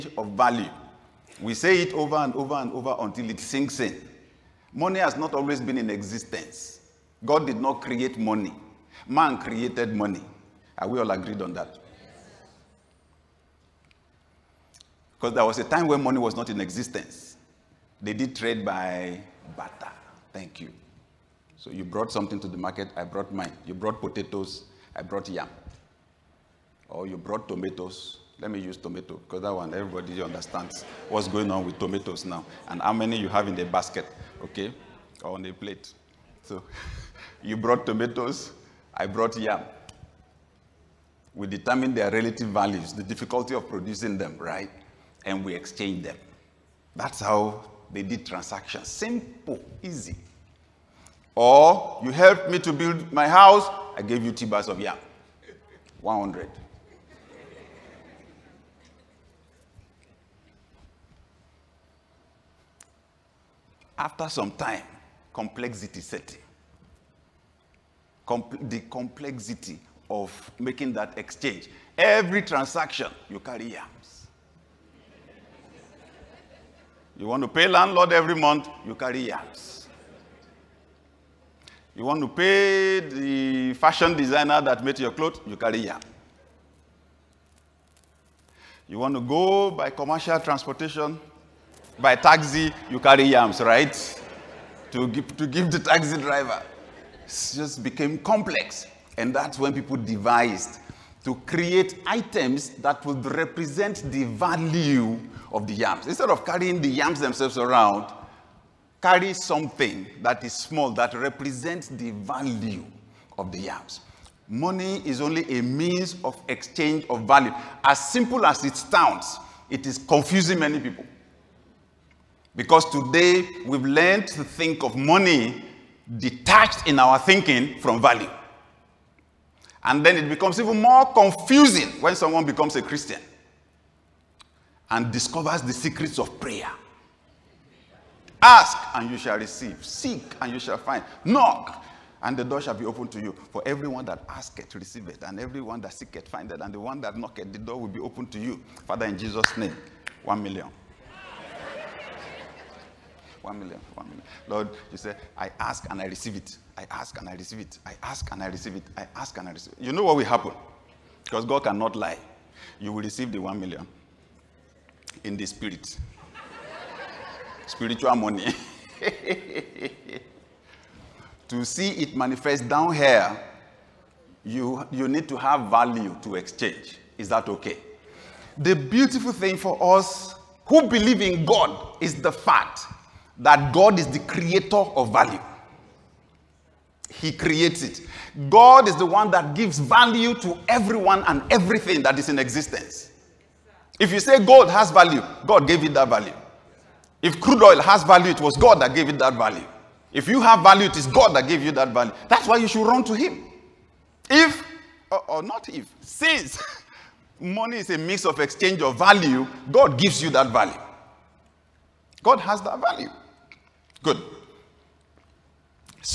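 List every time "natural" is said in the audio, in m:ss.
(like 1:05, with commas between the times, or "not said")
not said.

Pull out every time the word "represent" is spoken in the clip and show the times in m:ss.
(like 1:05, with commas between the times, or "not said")
1:43, 1:51.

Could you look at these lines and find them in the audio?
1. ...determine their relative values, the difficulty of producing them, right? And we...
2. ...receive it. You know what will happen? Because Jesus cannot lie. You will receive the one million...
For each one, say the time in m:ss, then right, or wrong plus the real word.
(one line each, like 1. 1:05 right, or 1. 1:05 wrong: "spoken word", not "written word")
1. 0:41 right
2. 2:39 wrong: "God", not "Jesus".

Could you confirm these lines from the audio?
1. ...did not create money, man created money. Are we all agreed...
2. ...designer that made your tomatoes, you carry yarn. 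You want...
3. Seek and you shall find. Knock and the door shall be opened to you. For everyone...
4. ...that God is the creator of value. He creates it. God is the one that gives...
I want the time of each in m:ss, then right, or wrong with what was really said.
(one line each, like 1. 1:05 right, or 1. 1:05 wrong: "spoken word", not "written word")
1. 0:07 right
2. 1:24 wrong: "clothes", not "tomatoes"
3. 2:19 right
4. 3:03 right.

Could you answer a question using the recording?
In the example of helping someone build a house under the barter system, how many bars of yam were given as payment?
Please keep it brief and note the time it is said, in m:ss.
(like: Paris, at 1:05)
2, at 0:54.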